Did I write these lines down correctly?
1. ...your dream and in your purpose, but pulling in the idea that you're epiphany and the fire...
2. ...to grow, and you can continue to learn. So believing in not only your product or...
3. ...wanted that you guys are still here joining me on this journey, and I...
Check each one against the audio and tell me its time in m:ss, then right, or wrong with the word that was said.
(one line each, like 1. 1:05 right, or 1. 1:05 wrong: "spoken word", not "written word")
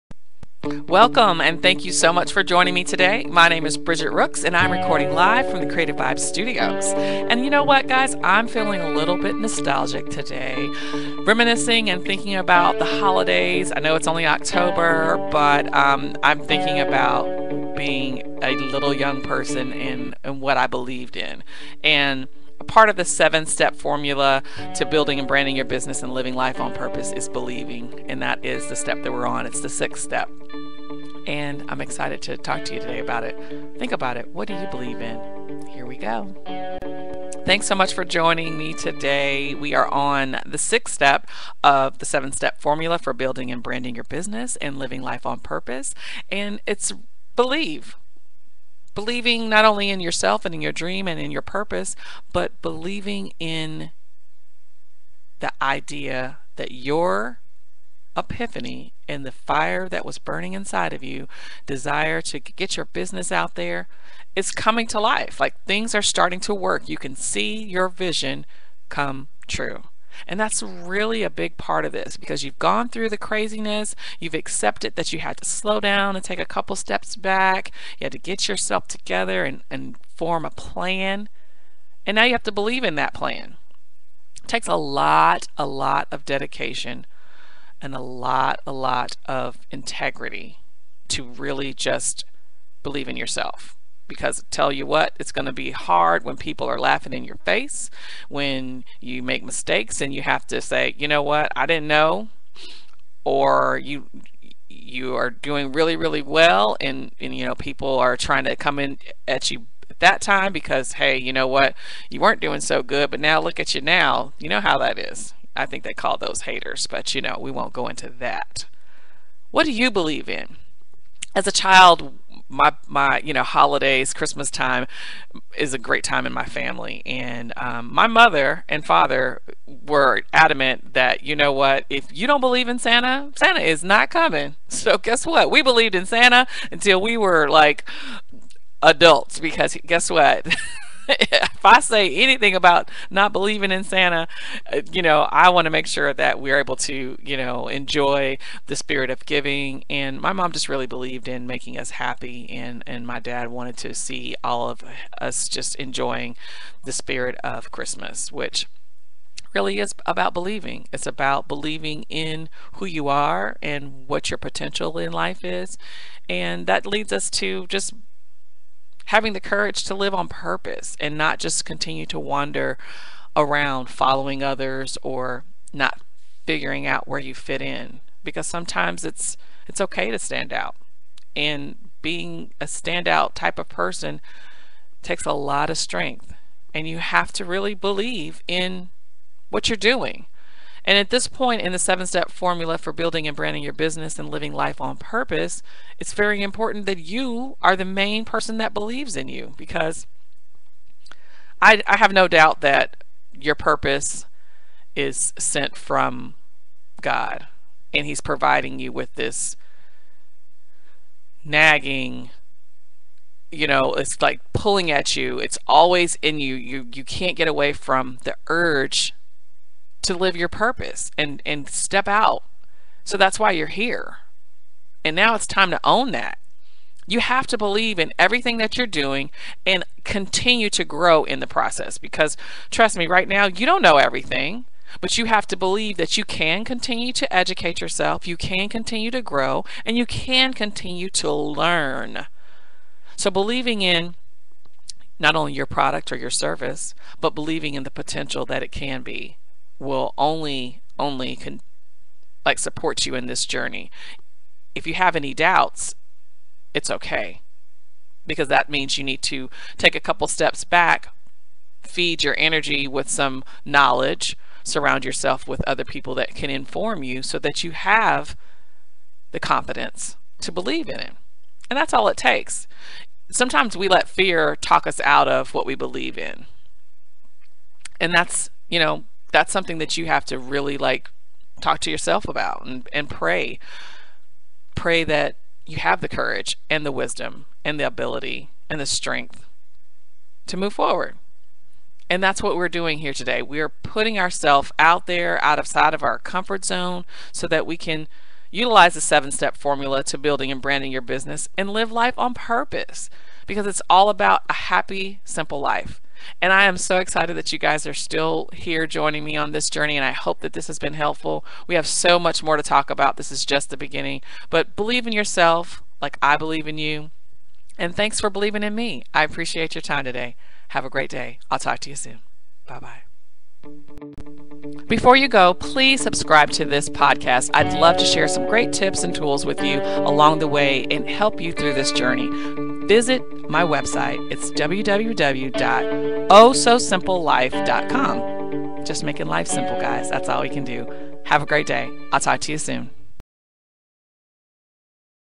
1. 0:50 wrong: "believing", not "pulling"
2. 3:59 right
3. 5:06 wrong: "excited", not "wanted".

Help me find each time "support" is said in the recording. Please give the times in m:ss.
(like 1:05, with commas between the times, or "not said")
4:12.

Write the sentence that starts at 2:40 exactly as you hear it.
It's about believing in who you are and what your potential in life is.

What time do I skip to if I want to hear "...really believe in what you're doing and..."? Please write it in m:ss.
3:07.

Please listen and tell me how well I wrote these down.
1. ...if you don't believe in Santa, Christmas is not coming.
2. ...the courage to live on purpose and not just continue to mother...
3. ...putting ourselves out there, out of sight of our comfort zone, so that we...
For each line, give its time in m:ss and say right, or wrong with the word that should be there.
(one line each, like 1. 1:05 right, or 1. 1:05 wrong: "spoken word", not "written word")
1. 2:11 wrong: "Santa", not "Christmas"
2. 2:49 wrong: "wander", not "mother"
3. 4:53 right.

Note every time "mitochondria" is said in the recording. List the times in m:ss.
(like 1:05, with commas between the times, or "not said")
not said.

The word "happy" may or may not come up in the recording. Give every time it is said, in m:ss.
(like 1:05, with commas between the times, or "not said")
2:31, 5:04.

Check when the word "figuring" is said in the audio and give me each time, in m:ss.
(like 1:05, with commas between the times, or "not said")
2:56.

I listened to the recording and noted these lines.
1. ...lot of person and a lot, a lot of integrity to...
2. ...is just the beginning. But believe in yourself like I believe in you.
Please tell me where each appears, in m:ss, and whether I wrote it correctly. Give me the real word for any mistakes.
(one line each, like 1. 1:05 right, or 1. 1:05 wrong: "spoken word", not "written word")
1. 1:25 wrong: "dedication", not "person"
2. 5:13 right.